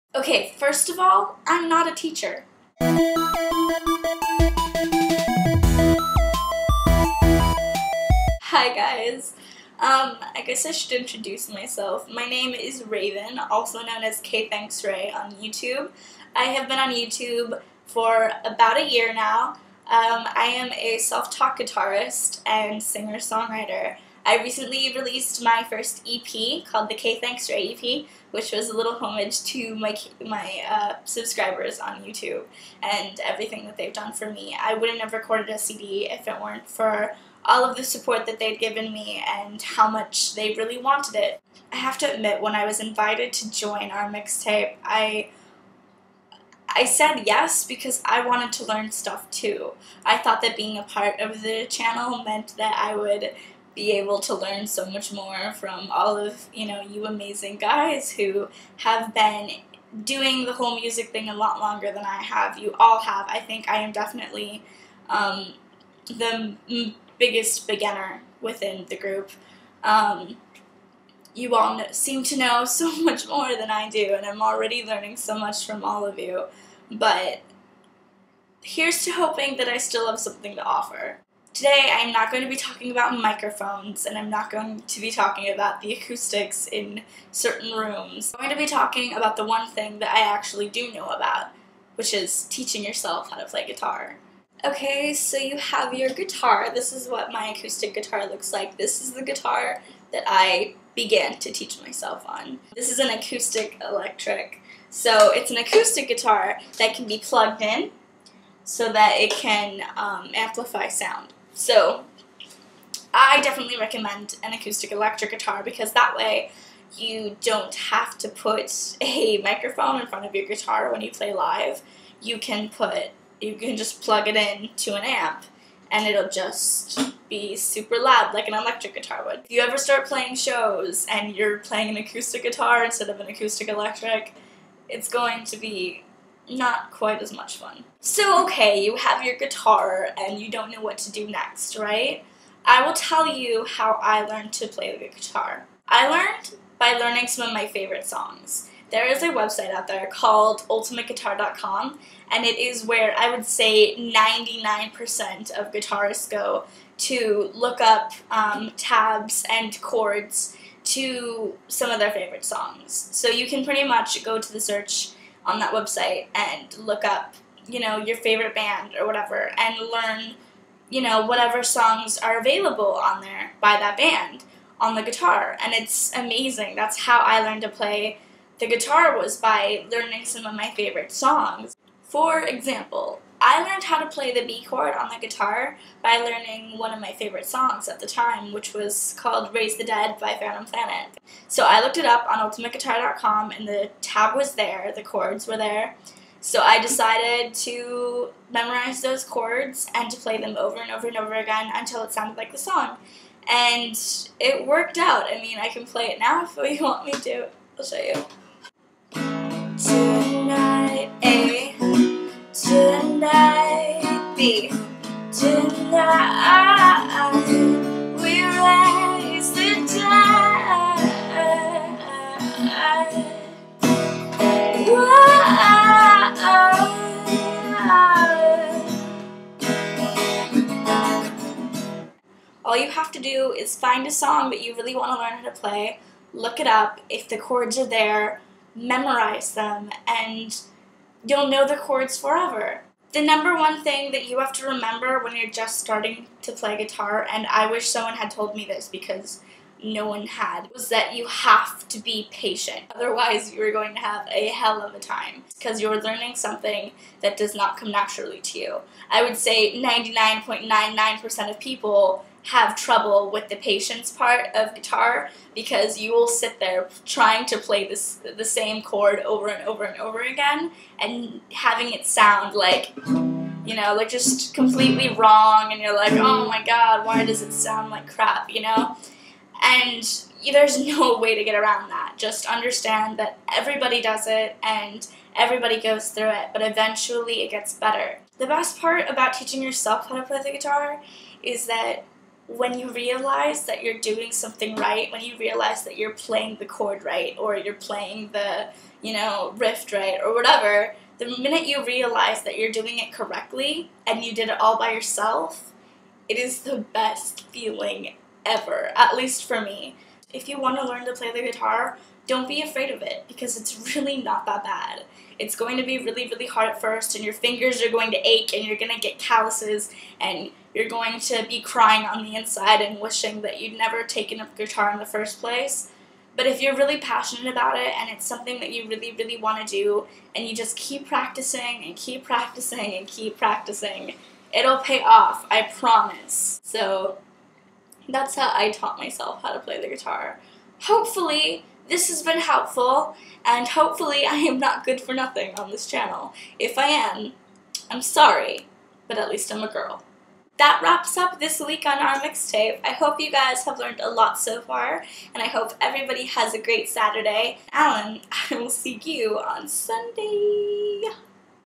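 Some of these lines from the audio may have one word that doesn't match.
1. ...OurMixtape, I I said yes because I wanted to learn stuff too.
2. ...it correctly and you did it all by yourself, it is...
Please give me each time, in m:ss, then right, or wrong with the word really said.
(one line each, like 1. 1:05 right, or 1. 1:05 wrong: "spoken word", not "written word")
1. 0:43 right
2. 5:02 right.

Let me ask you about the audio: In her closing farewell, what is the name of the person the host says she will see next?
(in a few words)
Alan.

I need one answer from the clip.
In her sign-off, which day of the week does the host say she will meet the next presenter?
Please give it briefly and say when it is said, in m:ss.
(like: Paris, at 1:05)
Sunday, at 5:59.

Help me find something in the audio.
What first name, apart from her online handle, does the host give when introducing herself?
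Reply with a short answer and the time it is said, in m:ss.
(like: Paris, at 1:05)
Raven, at 0:12.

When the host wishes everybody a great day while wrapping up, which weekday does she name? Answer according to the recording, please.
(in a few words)
Saturday.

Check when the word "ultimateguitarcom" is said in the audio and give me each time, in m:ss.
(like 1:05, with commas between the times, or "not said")
2:30, 3:12.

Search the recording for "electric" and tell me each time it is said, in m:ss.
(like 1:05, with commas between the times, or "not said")
1:43, 1:54, 2:08, 2:13.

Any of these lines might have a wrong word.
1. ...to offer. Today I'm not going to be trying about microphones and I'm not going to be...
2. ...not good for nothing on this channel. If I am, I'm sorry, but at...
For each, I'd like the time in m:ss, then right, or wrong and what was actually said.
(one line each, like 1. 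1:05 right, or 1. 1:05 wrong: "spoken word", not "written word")
1. 1:20 wrong: "talking", not "trying"
2. 5:44 right.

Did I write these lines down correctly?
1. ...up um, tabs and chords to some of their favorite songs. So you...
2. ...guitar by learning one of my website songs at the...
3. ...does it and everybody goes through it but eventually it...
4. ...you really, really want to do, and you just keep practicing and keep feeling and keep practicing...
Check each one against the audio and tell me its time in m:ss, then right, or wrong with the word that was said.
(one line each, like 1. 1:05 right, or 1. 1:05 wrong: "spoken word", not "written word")
1. 2:37 right
2. 3:05 wrong: "favorite", not "website"
3. 4:44 right
4. 5:28 wrong: "practicing", not "feeling".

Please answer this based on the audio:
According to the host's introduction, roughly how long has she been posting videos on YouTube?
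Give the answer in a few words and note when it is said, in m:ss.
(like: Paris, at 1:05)
About a year, at 0:18.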